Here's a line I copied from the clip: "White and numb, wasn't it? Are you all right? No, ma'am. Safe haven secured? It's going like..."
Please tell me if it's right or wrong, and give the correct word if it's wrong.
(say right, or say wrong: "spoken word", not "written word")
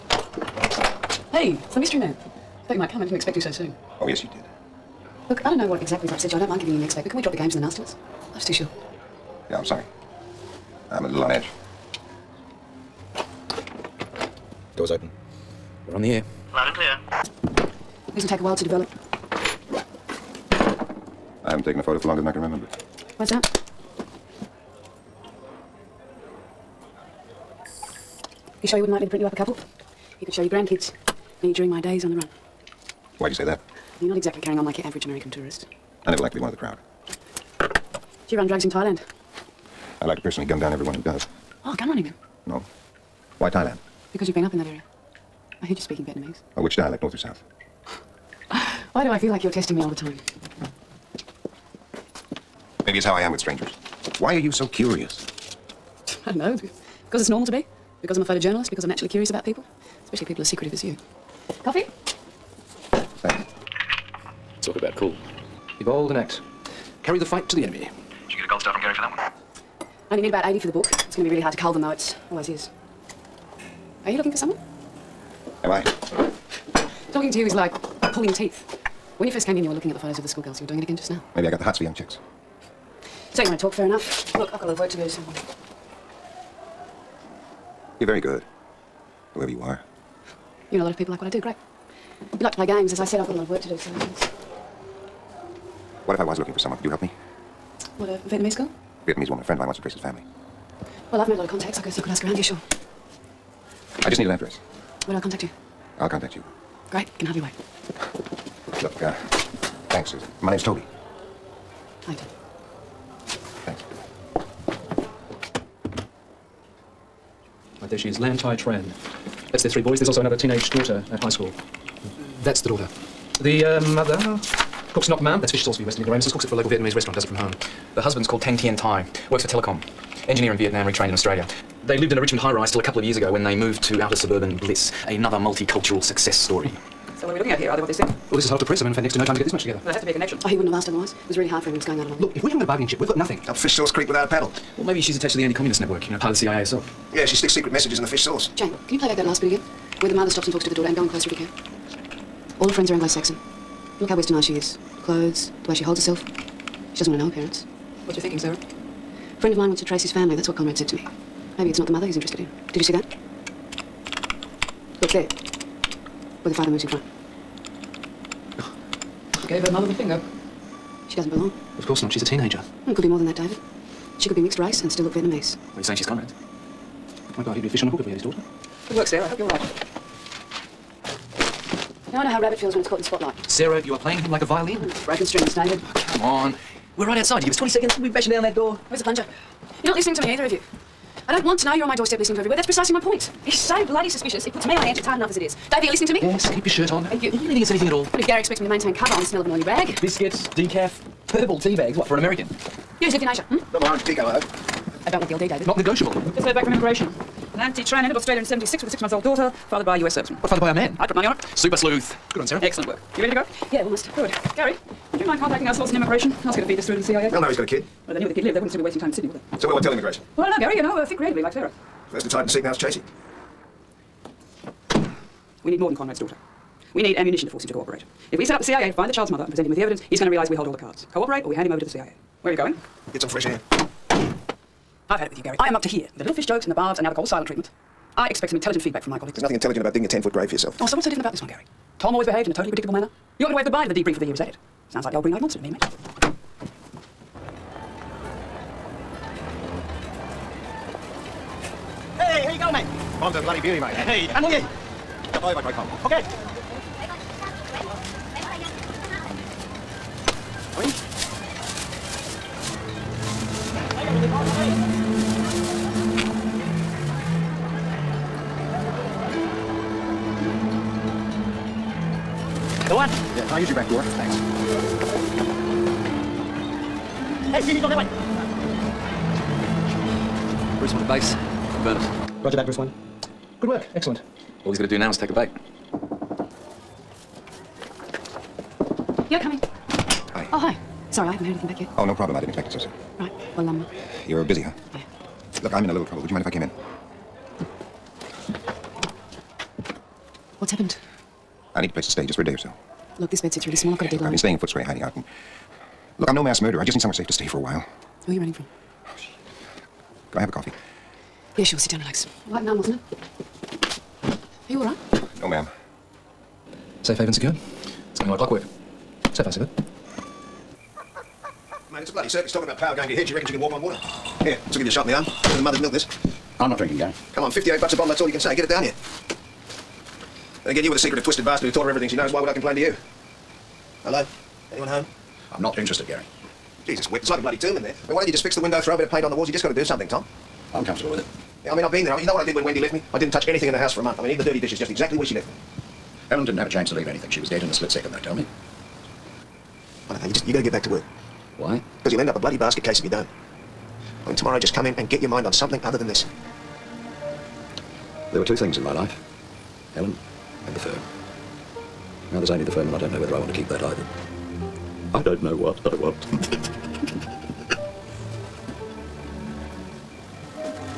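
right.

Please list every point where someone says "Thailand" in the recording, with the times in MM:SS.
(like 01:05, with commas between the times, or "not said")
00:38, 00:43.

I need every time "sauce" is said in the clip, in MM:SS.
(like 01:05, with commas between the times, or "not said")
02:05, 02:23, 02:28.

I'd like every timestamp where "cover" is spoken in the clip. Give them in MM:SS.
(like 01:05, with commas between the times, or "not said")
03:18.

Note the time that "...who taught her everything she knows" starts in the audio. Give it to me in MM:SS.
05:31.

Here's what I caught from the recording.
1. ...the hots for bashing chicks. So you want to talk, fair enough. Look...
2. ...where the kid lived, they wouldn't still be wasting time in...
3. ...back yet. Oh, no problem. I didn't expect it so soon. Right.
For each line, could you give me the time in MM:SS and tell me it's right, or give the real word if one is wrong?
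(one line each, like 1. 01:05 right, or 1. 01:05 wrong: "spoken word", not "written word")
1. 01:21 wrong: "young", not "bashing"
2. 03:38 right
3. 04:51 right.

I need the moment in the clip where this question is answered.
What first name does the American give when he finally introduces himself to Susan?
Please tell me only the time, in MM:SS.
01:50.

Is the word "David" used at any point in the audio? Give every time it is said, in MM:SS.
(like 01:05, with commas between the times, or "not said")
02:53, 03:05, 03:15, 03:25.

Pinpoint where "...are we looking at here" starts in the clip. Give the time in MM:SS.
02:17.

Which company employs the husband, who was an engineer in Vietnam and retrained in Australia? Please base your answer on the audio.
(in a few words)
Telecom.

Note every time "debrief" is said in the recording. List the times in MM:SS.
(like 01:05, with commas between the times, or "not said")
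04:03.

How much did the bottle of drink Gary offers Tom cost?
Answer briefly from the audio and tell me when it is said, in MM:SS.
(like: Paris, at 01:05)
$58, at 05:27.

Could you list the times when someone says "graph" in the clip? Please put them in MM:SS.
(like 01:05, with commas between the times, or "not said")
not said.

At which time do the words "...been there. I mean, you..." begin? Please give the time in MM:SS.
05:41.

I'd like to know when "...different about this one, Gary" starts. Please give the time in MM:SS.
04:01.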